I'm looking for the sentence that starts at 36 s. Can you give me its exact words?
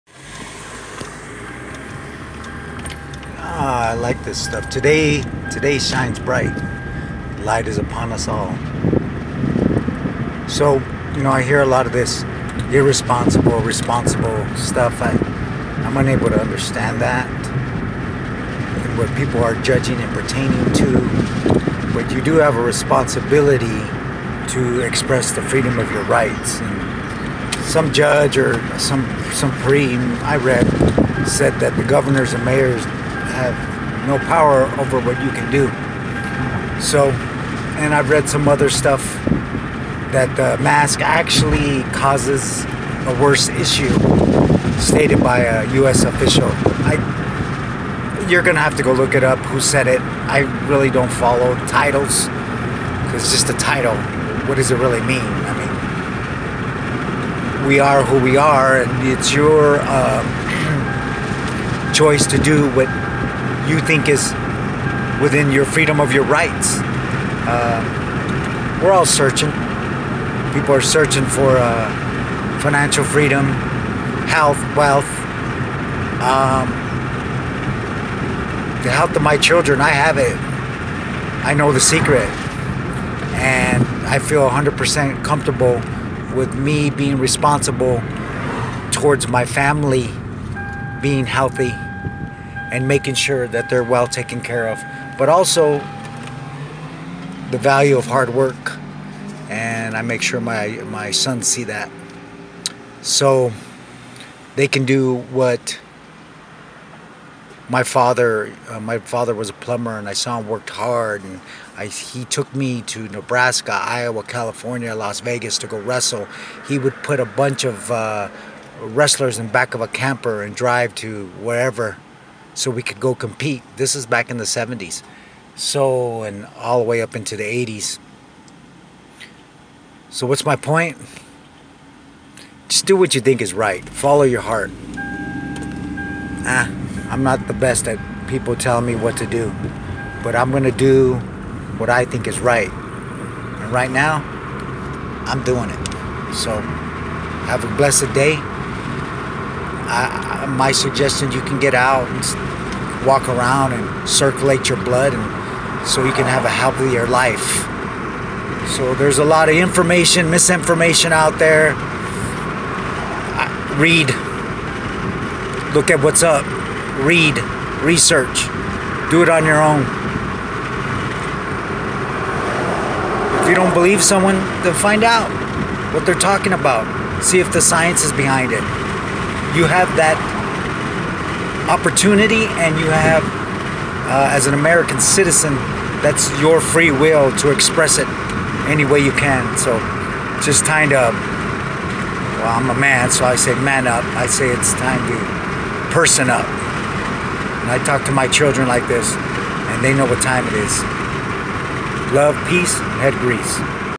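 So, and I've read some other stuff that the mask actually causes a worse issue, stated by a U.S.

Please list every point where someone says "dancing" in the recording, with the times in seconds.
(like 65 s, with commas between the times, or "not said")
not said.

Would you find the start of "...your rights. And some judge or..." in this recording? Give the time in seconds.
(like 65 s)
25 s.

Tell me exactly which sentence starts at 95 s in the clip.
But also the value of hard work and I make sure my, my sons see that.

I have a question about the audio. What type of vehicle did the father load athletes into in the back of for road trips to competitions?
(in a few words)
camper.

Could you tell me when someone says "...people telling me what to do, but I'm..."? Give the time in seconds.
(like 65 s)
138 s.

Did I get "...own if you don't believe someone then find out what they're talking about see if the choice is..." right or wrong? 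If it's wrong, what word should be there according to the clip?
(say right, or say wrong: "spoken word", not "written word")
wrong: "science", not "choice".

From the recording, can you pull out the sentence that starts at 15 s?
I, I'm unable to understand that.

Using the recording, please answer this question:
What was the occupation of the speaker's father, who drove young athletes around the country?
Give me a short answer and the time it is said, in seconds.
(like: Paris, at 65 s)
plumber, at 109 s.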